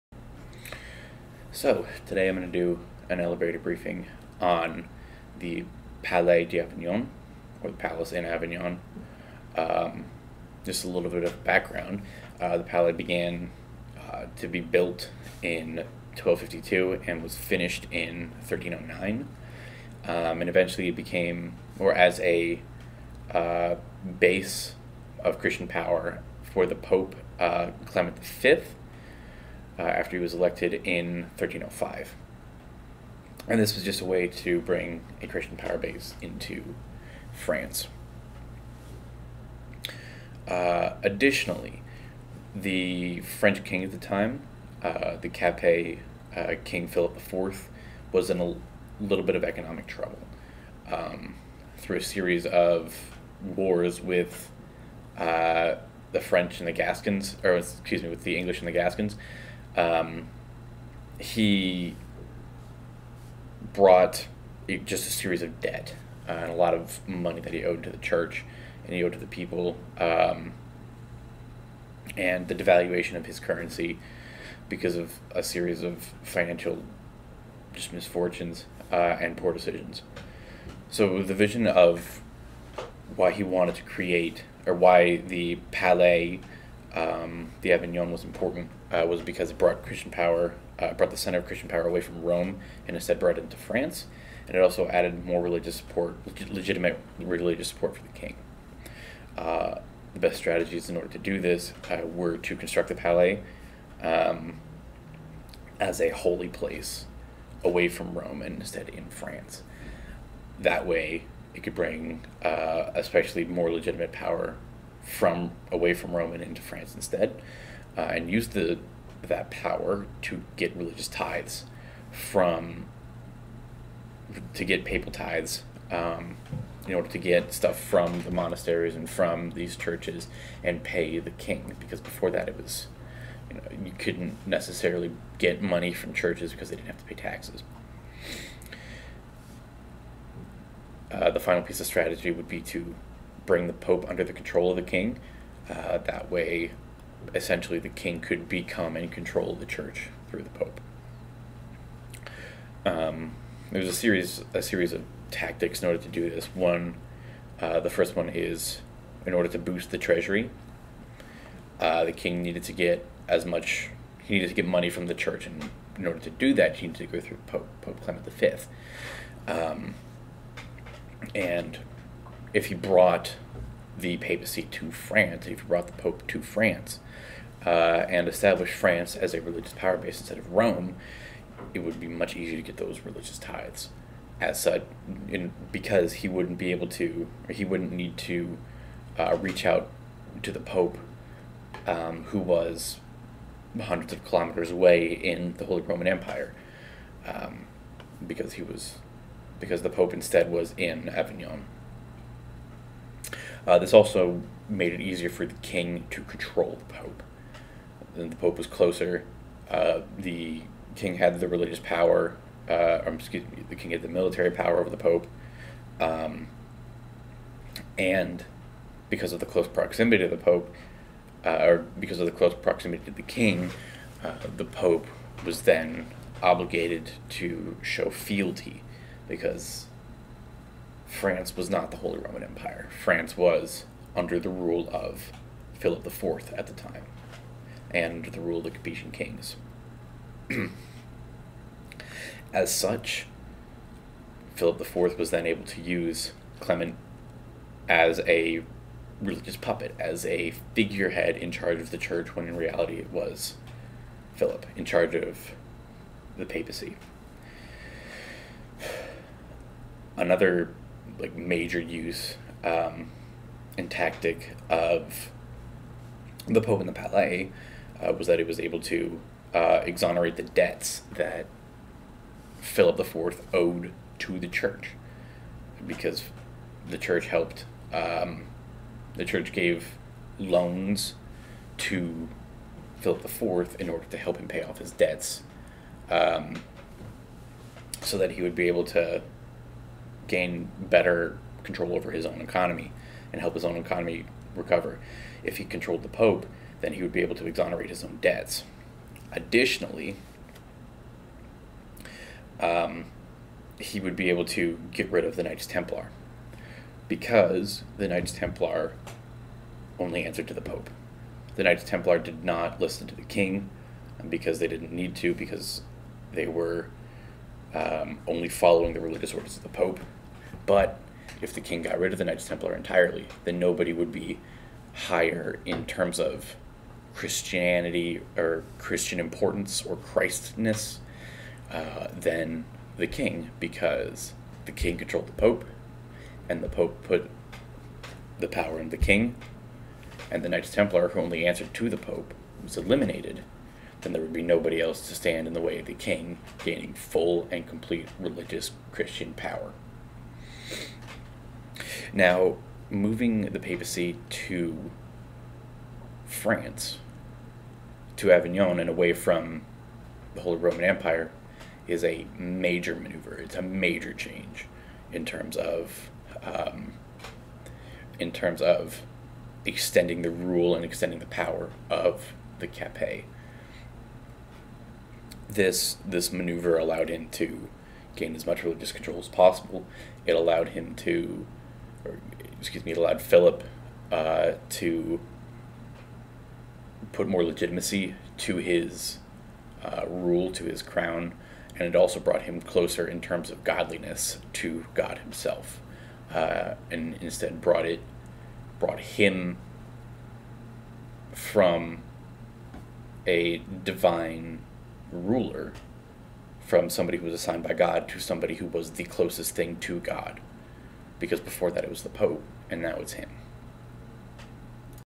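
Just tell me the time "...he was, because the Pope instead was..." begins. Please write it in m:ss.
3:18.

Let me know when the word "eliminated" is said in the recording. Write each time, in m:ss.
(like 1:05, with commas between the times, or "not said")
5:42.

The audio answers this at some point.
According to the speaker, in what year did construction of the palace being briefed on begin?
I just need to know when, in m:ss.
0:16.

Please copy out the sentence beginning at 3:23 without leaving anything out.
Uh, this also made it easier for the king to control the pope.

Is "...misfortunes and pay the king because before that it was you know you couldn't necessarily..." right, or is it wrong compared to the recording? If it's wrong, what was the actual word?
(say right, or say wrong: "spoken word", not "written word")
wrong: "churches", not "misfortunes".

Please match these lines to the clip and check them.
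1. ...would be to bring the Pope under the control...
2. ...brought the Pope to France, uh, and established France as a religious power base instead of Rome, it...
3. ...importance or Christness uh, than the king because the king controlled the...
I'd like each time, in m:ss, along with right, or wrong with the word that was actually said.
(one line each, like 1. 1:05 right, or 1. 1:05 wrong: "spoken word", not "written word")
1. 2:22 right
2. 2:55 right
3. 5:29 right.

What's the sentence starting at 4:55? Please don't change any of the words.
If he controlled the Pope, then he would be able to exonerate his own debts.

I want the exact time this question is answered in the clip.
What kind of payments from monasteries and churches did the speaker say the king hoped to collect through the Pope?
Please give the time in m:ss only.
2:04.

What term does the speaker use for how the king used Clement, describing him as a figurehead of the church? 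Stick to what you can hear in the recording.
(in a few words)
Religious puppet.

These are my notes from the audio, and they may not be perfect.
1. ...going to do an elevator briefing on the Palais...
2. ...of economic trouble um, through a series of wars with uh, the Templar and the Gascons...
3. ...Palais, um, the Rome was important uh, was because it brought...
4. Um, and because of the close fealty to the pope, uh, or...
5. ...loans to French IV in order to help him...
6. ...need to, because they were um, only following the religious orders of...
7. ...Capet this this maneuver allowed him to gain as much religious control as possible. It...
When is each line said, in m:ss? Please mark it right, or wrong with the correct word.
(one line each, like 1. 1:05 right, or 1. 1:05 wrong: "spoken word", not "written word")
1. 0:02 right
2. 0:49 wrong: "French", not "Templar"
3. 1:25 wrong: "Avignon", not "Rome"
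4. 3:35 wrong: "proximity", not "fealty"
5. 4:40 wrong: "Philip", not "French"
6. 5:14 right
7. 6:12 right.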